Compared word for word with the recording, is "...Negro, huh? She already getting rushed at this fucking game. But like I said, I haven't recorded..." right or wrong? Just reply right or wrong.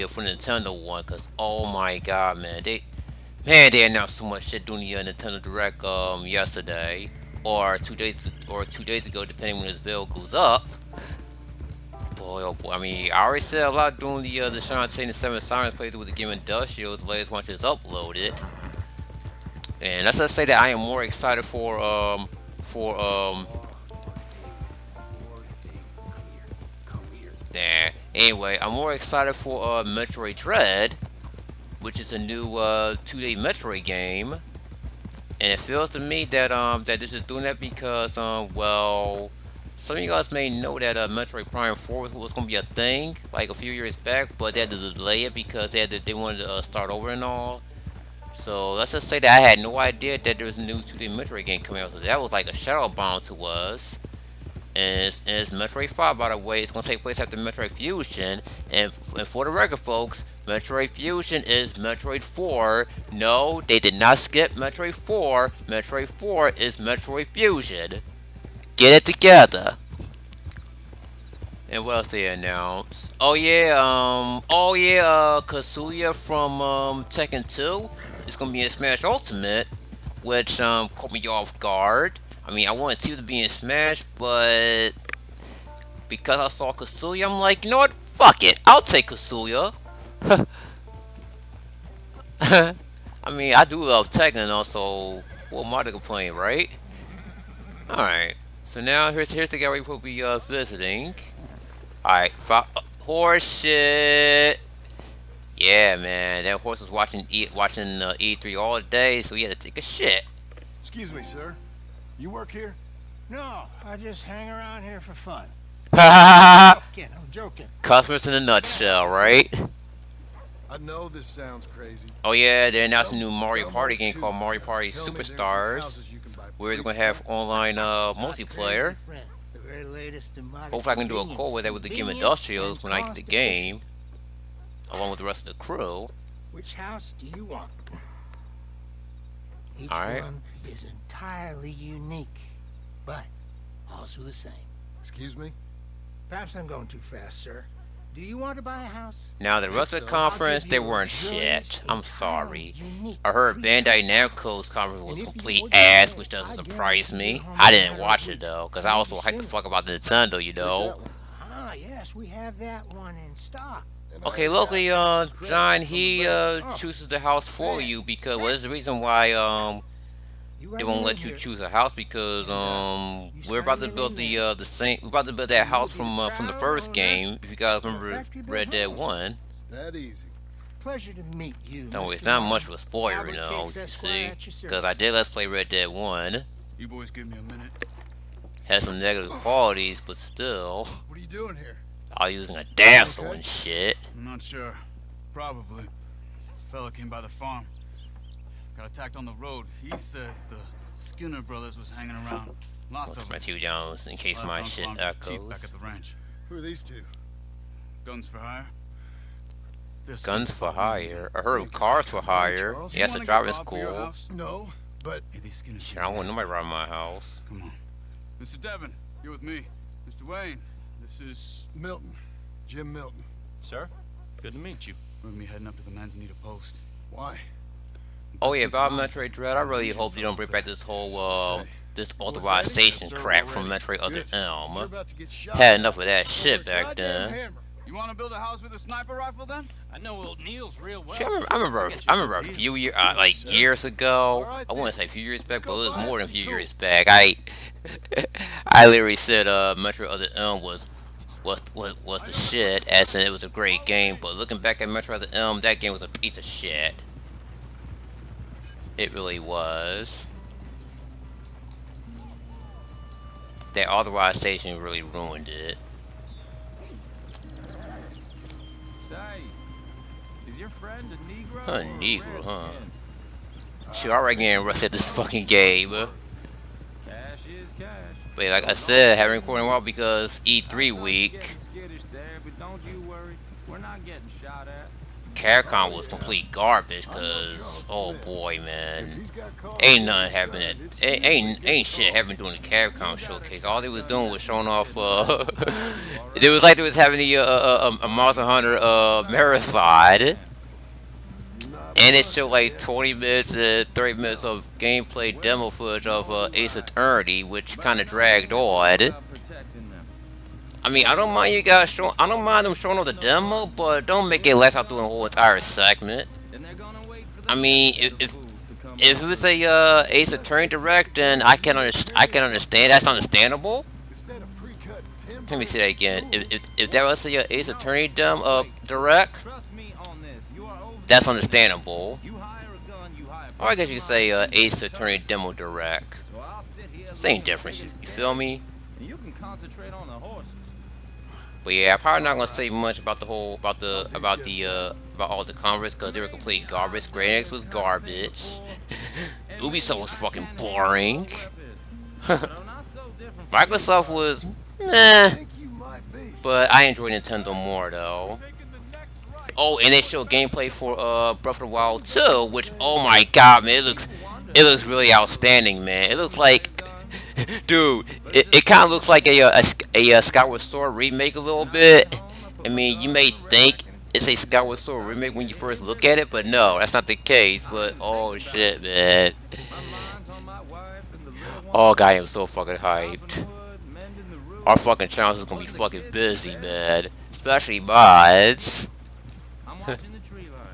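right.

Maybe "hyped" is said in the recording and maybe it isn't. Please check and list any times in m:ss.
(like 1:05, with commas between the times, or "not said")
2:39, 6:22.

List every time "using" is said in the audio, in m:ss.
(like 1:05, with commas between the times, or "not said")
3:12.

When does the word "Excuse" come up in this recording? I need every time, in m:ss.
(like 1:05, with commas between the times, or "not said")
1:50, 2:24.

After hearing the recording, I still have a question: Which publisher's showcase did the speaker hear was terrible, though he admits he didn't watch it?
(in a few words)
Bandai Namco.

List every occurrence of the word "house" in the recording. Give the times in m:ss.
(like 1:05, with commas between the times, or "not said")
2:16, 2:28, 2:47, 2:51, 2:55, 3:36, 3:58.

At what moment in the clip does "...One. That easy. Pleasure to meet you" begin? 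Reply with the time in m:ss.
2:58.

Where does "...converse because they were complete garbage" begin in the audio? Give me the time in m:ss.
5:45.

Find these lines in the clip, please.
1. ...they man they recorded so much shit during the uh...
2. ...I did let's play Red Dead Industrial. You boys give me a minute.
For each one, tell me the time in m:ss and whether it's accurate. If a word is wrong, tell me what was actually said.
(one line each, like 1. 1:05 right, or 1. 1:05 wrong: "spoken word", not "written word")
1. 0:02 wrong: "announced", not "recorded"
2. 3:04 wrong: "One", not "Industrial".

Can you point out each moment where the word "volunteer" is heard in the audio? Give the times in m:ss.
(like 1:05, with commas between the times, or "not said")
not said.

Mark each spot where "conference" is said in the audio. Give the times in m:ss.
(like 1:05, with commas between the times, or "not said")
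2:30, 2:34.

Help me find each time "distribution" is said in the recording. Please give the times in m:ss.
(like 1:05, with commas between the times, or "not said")
not said.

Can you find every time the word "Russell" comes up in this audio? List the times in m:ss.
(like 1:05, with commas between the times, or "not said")
2:29.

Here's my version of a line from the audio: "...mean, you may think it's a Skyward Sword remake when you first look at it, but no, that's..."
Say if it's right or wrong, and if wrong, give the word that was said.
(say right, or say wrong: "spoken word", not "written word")
right.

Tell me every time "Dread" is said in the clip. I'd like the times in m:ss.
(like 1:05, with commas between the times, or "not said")
0:30, 3:49.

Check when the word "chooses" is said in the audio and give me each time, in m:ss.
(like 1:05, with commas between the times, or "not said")
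2:46, 2:51.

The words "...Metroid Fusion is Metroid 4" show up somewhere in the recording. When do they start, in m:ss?
1:00.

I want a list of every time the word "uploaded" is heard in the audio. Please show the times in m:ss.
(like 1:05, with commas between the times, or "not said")
0:17.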